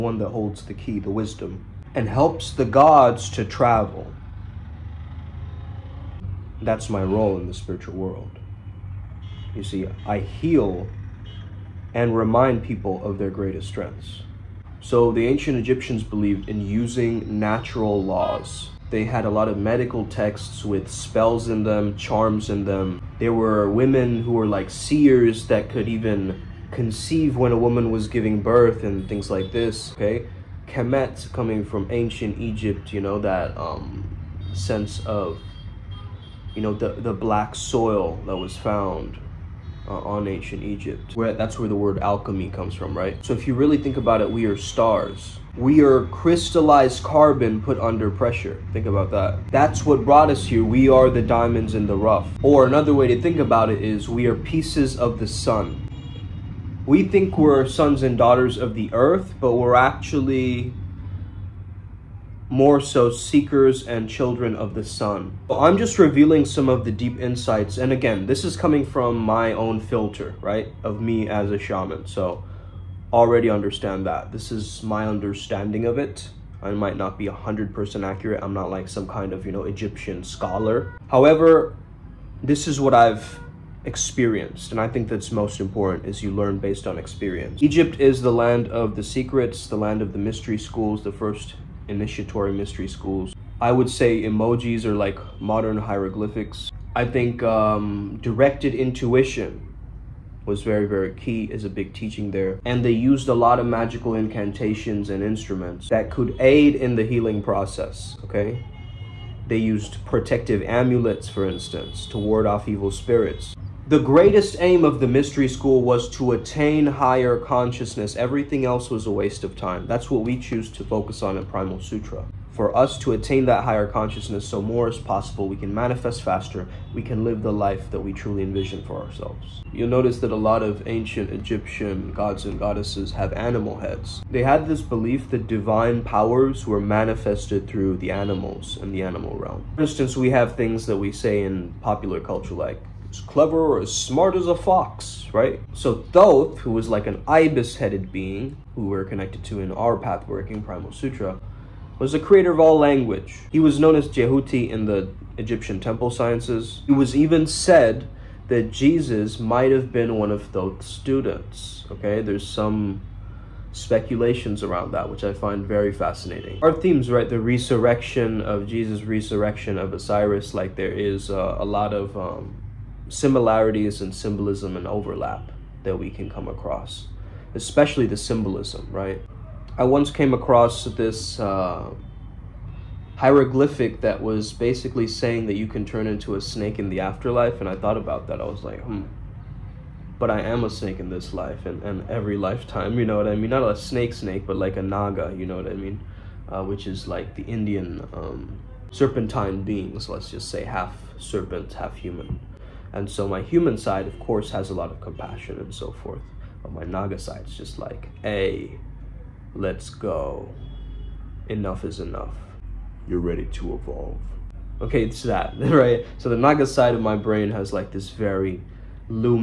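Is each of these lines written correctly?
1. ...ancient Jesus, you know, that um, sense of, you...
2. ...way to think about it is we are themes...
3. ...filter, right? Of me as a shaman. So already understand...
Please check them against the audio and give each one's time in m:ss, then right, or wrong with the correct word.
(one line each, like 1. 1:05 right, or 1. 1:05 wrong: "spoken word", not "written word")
1. 0:31 wrong: "Egypt", not "Jesus"
2. 0:52 wrong: "pieces", not "themes"
3. 1:09 right.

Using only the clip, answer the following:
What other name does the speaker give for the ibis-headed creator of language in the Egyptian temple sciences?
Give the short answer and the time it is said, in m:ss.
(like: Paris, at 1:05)
Jehuti, at 2:34.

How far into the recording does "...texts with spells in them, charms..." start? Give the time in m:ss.
0:20.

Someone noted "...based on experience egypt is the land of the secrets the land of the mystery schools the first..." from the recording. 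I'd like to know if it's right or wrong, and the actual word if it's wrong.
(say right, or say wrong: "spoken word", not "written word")
right.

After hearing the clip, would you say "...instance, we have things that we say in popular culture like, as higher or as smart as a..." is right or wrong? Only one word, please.
wrong.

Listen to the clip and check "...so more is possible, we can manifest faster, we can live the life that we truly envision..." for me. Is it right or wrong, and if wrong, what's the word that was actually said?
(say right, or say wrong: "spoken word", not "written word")
right.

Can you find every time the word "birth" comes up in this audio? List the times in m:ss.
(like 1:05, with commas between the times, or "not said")
0:28.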